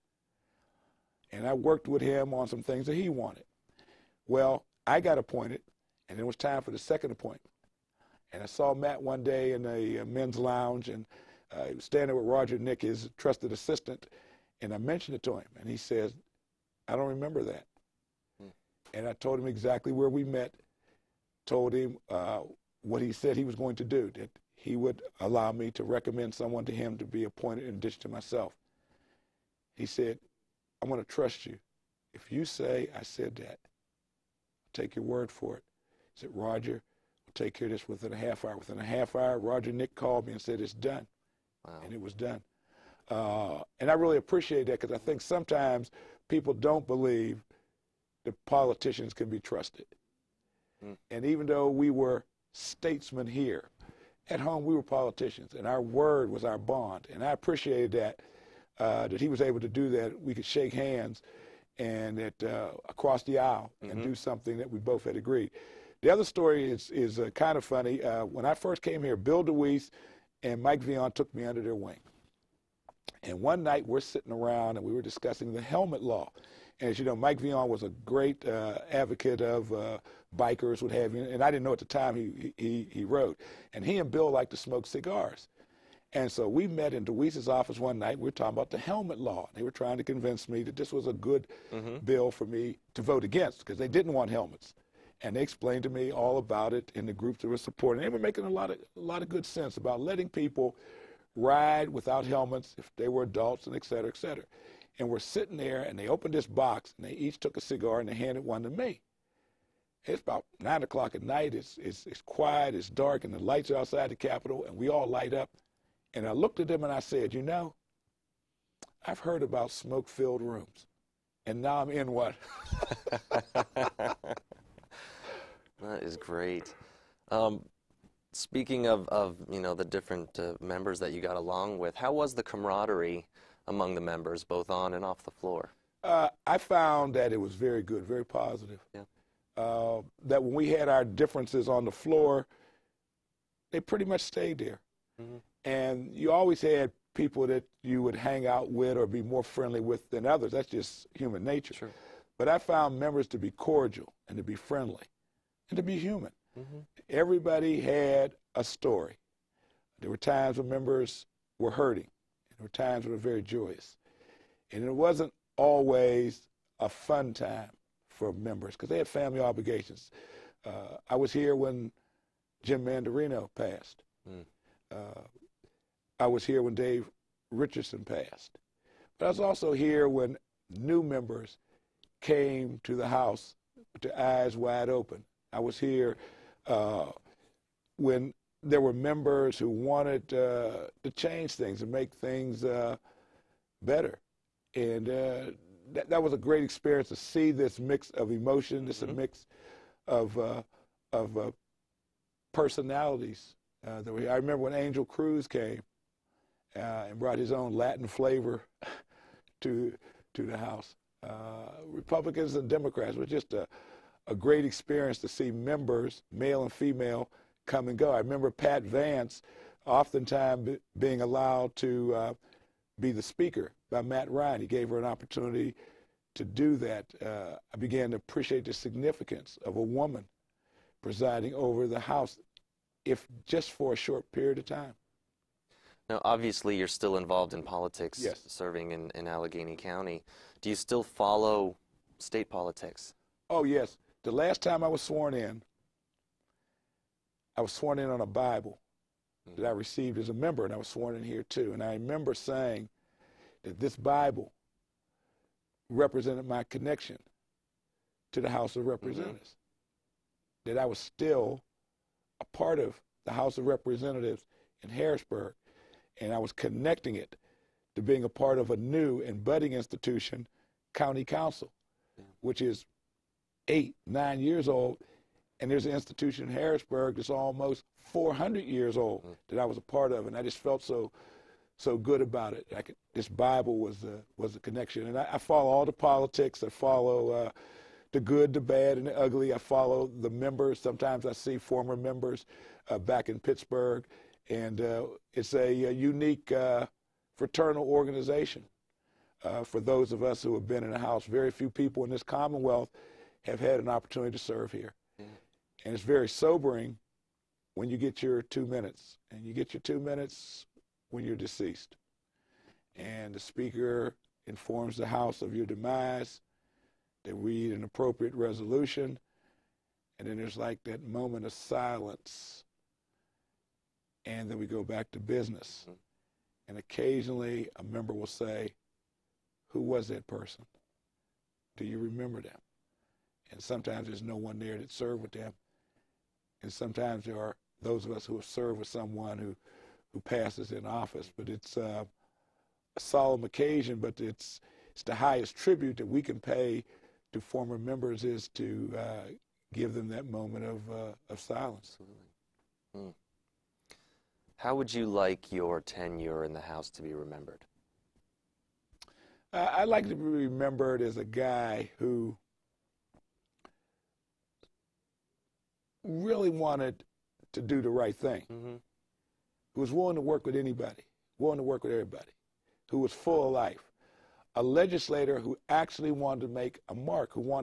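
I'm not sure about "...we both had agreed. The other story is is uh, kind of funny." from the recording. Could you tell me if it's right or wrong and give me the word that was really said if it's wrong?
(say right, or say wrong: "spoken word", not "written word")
right.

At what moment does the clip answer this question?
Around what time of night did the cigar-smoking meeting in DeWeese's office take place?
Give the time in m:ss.
1:50.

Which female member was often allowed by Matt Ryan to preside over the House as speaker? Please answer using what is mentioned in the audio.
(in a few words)
Pat Vance.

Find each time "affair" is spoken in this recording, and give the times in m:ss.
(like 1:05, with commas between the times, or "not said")
not said.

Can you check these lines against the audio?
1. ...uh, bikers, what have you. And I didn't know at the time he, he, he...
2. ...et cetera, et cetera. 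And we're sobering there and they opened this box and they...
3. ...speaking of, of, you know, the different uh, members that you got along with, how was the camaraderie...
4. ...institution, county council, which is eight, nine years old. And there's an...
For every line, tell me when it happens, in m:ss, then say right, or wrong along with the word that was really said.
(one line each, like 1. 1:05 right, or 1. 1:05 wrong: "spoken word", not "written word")
1. 1:19 right
2. 1:43 wrong: "sitting", not "sobering"
3. 2:08 right
4. 4:29 right.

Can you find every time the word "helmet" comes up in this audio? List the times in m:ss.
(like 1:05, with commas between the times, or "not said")
1:15, 1:28, 1:34, 1:42.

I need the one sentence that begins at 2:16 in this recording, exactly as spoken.
Uh, I found that it was very good, very positive.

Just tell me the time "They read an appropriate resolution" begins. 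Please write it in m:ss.
5:17.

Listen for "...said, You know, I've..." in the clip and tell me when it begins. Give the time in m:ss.
1:56.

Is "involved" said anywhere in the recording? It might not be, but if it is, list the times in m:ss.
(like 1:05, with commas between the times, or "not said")
3:57.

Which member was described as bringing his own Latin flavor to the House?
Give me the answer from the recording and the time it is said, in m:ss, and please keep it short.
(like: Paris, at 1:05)
Angel Cruz, at 3:24.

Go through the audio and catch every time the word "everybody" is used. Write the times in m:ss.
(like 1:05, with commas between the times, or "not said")
2:37, 6:11.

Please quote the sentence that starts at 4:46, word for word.
I follow uh, the good, the bad, and the ugly.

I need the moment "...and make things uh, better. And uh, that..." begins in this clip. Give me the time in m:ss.
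3:11.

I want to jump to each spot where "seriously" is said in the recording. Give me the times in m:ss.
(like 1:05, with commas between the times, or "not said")
not said.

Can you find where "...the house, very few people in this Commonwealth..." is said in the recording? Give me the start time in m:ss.
5:00.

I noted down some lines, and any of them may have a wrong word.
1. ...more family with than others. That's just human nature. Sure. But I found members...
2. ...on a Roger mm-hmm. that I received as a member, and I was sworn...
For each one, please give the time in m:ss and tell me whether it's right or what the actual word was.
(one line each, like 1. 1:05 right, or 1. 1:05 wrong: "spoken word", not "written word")
1. 2:29 wrong: "friendly", not "family"
2. 4:08 wrong: "Bible", not "Roger".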